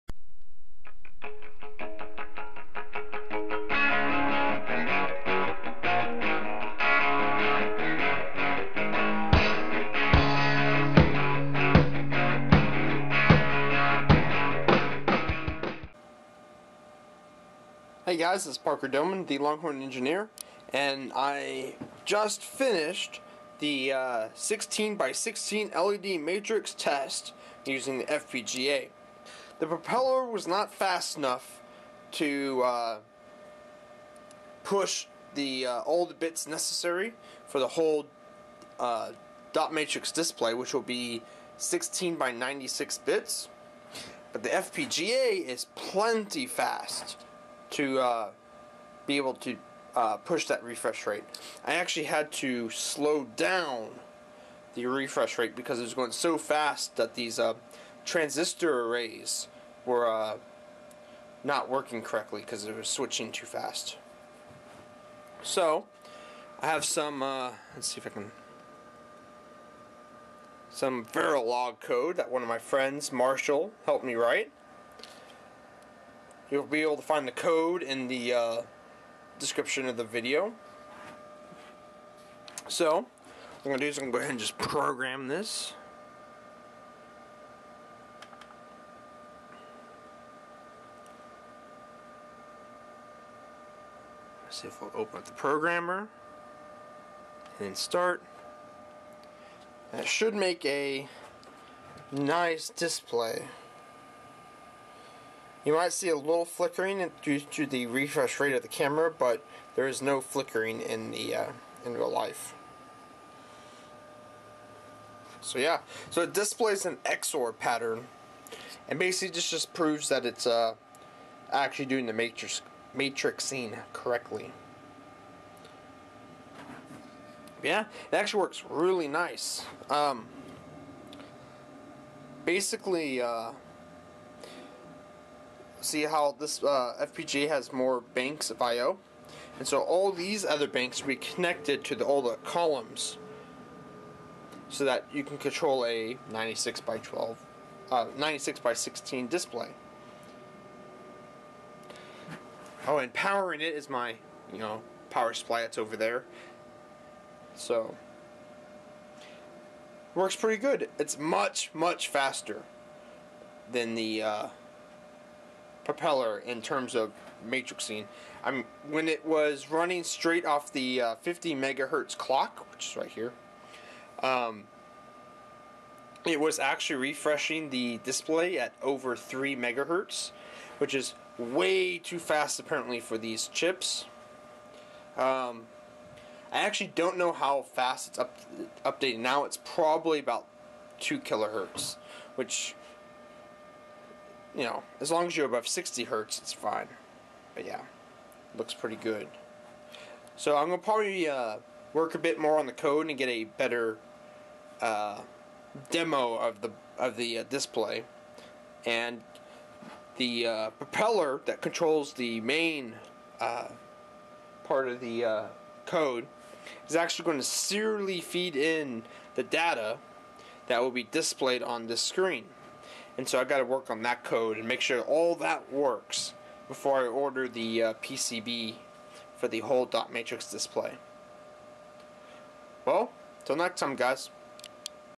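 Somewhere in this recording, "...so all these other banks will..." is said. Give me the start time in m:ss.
2:19.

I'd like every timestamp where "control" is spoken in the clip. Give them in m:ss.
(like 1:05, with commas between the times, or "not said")
2:25, 3:31.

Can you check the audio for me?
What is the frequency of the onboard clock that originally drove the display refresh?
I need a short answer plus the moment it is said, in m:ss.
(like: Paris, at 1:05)
50 megahertz, at 2:51.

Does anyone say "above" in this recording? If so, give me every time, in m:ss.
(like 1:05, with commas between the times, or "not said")
3:15.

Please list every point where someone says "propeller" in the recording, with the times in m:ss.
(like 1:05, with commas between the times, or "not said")
0:29, 2:45, 3:30.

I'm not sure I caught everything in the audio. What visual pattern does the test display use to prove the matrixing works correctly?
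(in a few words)
XOR pattern.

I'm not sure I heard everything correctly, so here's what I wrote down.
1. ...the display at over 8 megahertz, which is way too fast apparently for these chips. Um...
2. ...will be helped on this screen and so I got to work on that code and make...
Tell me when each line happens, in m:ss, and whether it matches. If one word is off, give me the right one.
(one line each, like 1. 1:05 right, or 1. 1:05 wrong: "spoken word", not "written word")
1. 2:57 wrong: "3", not "8"
2. 3:40 wrong: "displayed", not "helped".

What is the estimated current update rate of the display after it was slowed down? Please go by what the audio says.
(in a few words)
2 kilohertz.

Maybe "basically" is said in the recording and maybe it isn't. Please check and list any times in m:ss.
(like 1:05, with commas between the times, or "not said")
1:58, 2:12.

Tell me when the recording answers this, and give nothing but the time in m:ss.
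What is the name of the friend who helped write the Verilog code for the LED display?
1:13.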